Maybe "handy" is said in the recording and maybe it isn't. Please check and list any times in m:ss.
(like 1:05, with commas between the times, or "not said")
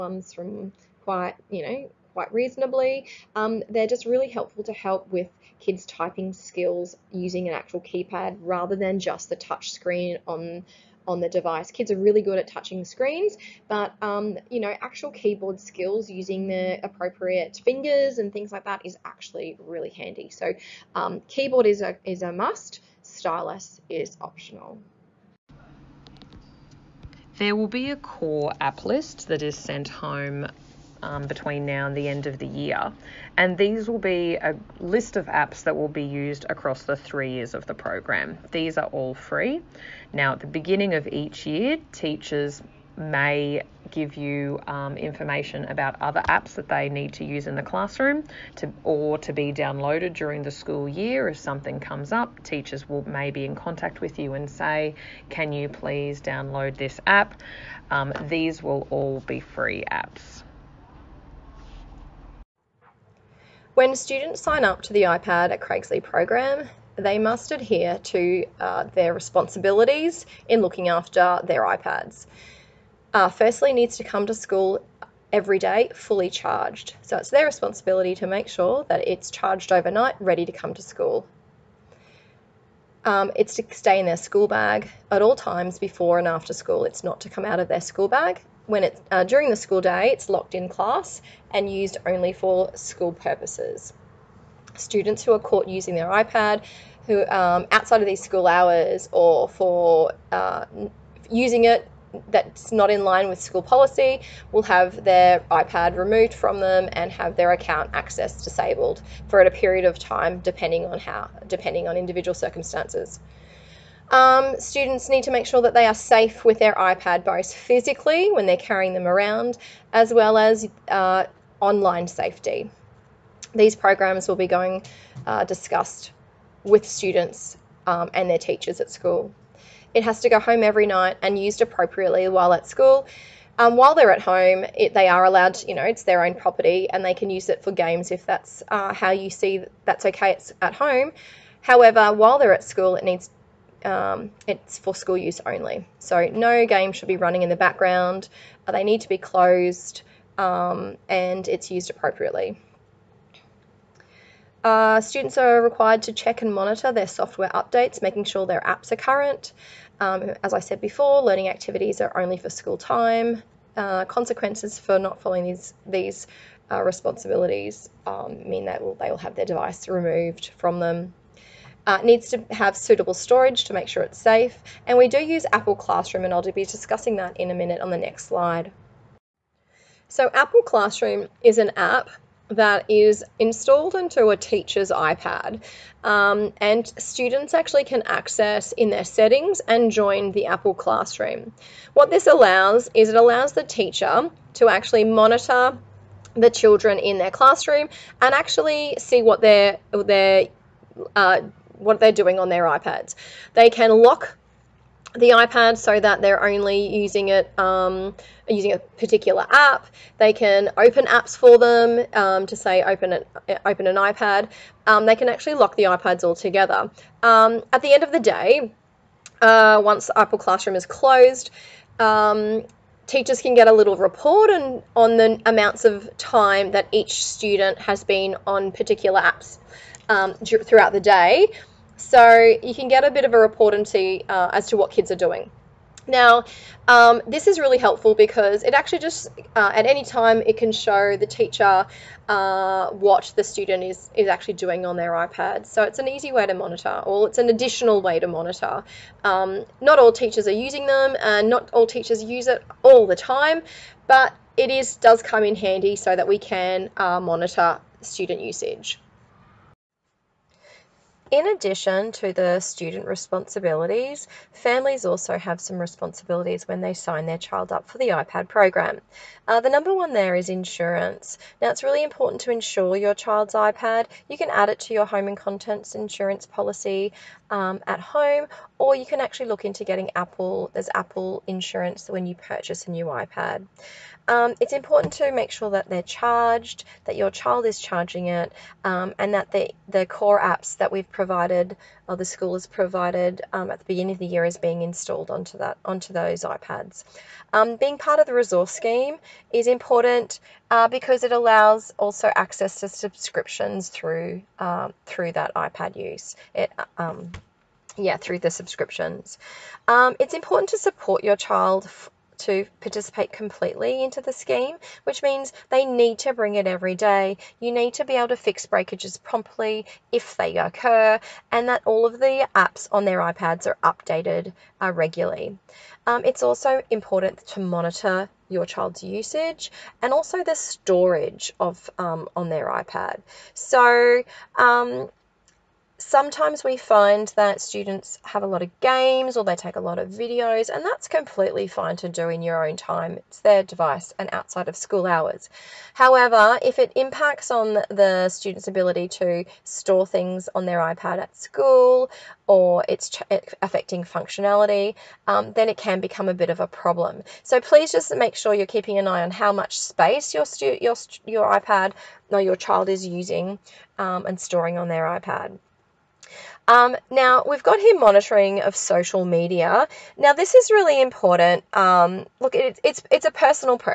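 0:19, 4:15.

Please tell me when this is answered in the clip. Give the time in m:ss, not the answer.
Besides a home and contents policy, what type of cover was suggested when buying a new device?
4:40.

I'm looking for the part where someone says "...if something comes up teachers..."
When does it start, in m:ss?
0:51.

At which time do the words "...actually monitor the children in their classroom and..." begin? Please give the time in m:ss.
3:14.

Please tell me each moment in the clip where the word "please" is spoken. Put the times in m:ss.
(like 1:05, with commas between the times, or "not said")
0:55, 5:57.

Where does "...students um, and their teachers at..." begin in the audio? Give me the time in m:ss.
2:06.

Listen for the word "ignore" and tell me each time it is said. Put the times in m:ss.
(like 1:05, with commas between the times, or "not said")
not said.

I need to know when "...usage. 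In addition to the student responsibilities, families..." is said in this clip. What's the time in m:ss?
4:18.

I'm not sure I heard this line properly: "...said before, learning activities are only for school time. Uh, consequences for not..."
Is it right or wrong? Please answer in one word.
right.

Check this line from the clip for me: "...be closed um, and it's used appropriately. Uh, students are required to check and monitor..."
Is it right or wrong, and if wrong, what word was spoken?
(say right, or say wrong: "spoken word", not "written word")
right.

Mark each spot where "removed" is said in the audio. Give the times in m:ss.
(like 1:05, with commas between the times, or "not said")
1:45, 2:49.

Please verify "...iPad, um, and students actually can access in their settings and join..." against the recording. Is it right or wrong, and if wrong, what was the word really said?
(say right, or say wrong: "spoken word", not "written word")
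right.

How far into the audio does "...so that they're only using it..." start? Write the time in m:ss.
3:25.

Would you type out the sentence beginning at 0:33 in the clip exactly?
And these will be a list of apps that will be used across the three years of the program.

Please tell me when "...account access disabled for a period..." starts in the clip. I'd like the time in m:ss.
1:47.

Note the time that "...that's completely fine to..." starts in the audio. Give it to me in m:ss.
5:40.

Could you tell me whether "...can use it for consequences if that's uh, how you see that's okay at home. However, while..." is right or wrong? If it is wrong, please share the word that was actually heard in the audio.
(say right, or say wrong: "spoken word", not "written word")
wrong: "games", not "consequences".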